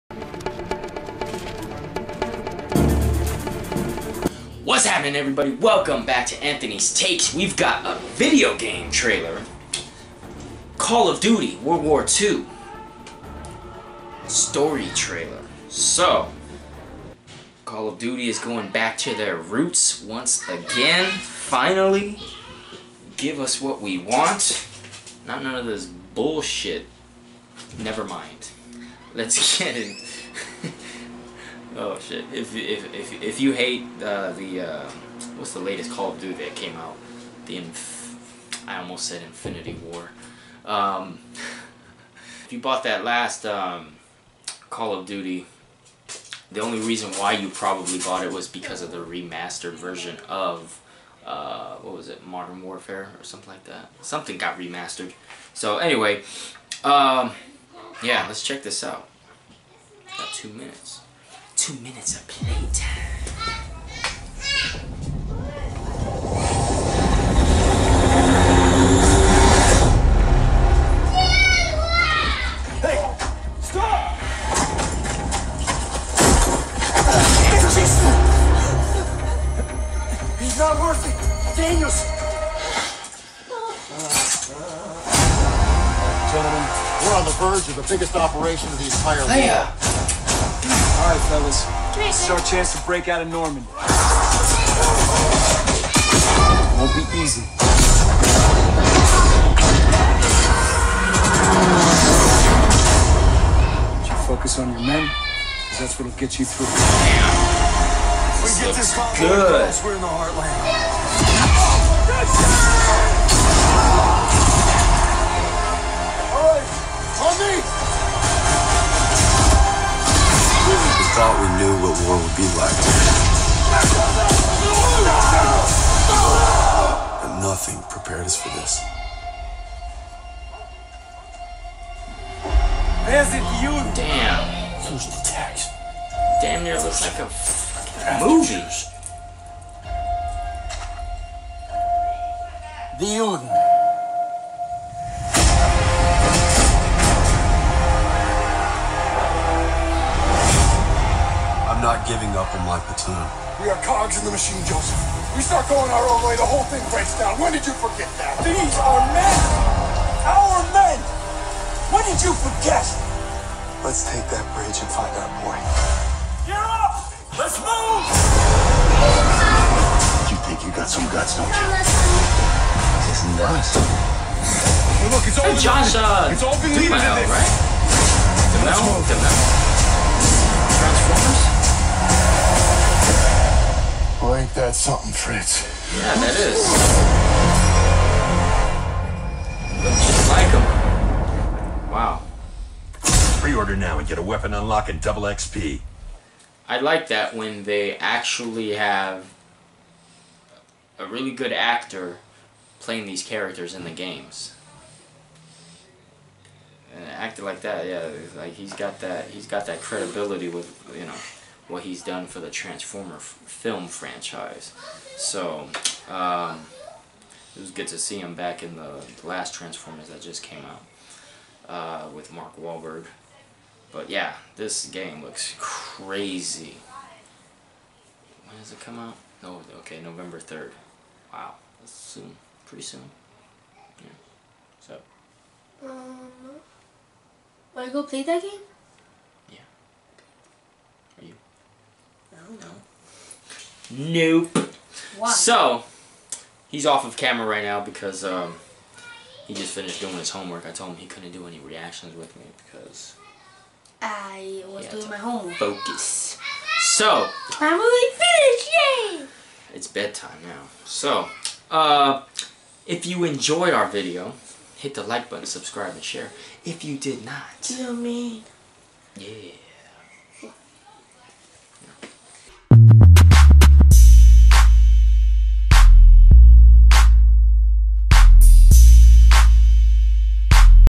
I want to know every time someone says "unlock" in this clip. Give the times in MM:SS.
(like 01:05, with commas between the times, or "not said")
03:14.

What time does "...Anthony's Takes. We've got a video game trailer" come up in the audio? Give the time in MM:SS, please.
00:06.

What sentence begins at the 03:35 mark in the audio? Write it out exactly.
So, um, it was good to see him back in the last Transformers that just came out uh, with Mark Wahlberg.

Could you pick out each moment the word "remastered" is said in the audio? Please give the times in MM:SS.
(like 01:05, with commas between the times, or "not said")
00:48, 00:54.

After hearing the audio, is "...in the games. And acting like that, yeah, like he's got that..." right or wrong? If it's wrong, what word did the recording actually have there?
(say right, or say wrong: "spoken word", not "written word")
right.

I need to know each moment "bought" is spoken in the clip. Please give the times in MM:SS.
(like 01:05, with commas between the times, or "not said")
00:42, 00:47.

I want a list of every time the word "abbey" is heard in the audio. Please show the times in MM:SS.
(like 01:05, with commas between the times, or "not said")
not said.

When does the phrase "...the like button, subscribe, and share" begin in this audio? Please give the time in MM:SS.
04:24.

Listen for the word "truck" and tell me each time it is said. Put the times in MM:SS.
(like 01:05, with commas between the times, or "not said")
not said.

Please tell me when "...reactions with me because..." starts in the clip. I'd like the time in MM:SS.
04:11.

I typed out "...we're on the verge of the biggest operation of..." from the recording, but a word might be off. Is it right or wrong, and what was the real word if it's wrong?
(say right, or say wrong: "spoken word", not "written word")
right.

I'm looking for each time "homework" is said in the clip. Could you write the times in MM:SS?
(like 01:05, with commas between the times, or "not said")
04:10, 04:15.